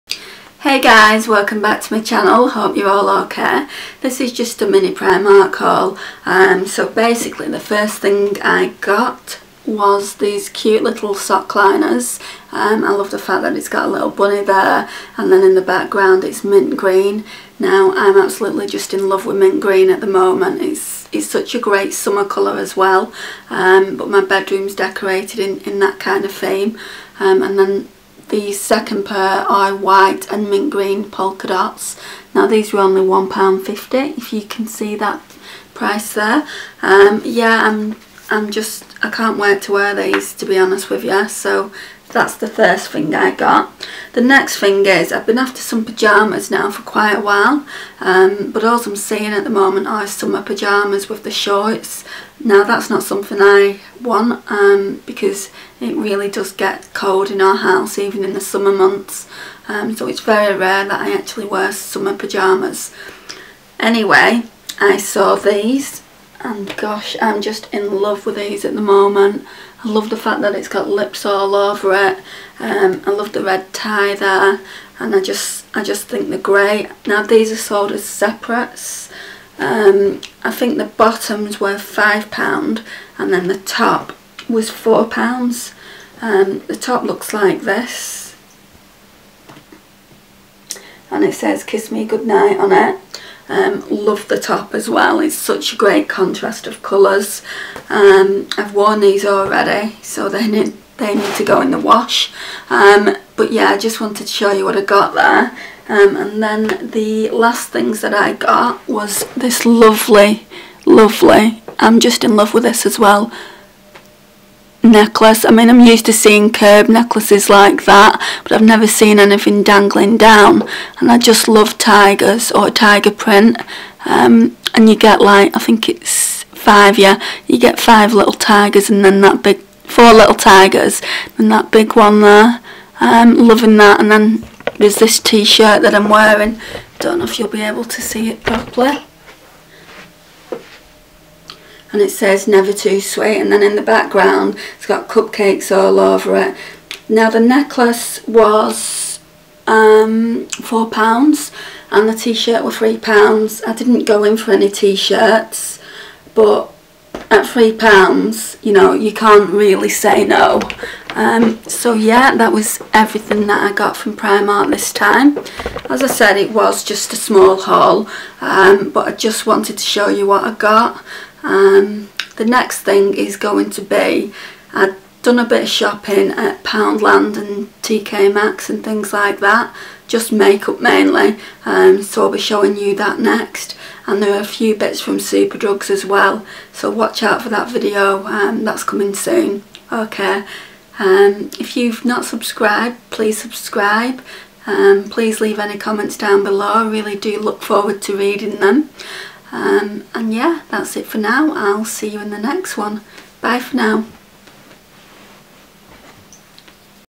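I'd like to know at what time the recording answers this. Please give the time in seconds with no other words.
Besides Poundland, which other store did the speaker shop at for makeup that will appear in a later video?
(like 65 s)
177 s.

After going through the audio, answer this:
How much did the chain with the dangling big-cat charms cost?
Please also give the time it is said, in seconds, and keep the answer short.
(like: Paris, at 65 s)
£4, at 150 s.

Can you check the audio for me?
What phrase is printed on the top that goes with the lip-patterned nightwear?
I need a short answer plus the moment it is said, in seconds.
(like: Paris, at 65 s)
kiss me goodnight, at 91 s.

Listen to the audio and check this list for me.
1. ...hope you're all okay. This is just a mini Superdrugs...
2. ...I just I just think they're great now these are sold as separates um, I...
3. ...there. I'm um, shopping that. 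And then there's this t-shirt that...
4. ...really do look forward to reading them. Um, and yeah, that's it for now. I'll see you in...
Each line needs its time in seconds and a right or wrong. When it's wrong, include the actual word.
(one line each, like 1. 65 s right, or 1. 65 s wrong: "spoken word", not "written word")
1. 2 s wrong: "Primark", not "Superdrugs"
2. 75 s right
3. 132 s wrong: "loving", not "shopping"
4. 196 s right.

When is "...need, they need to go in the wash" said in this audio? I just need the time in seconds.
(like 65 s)
100 s.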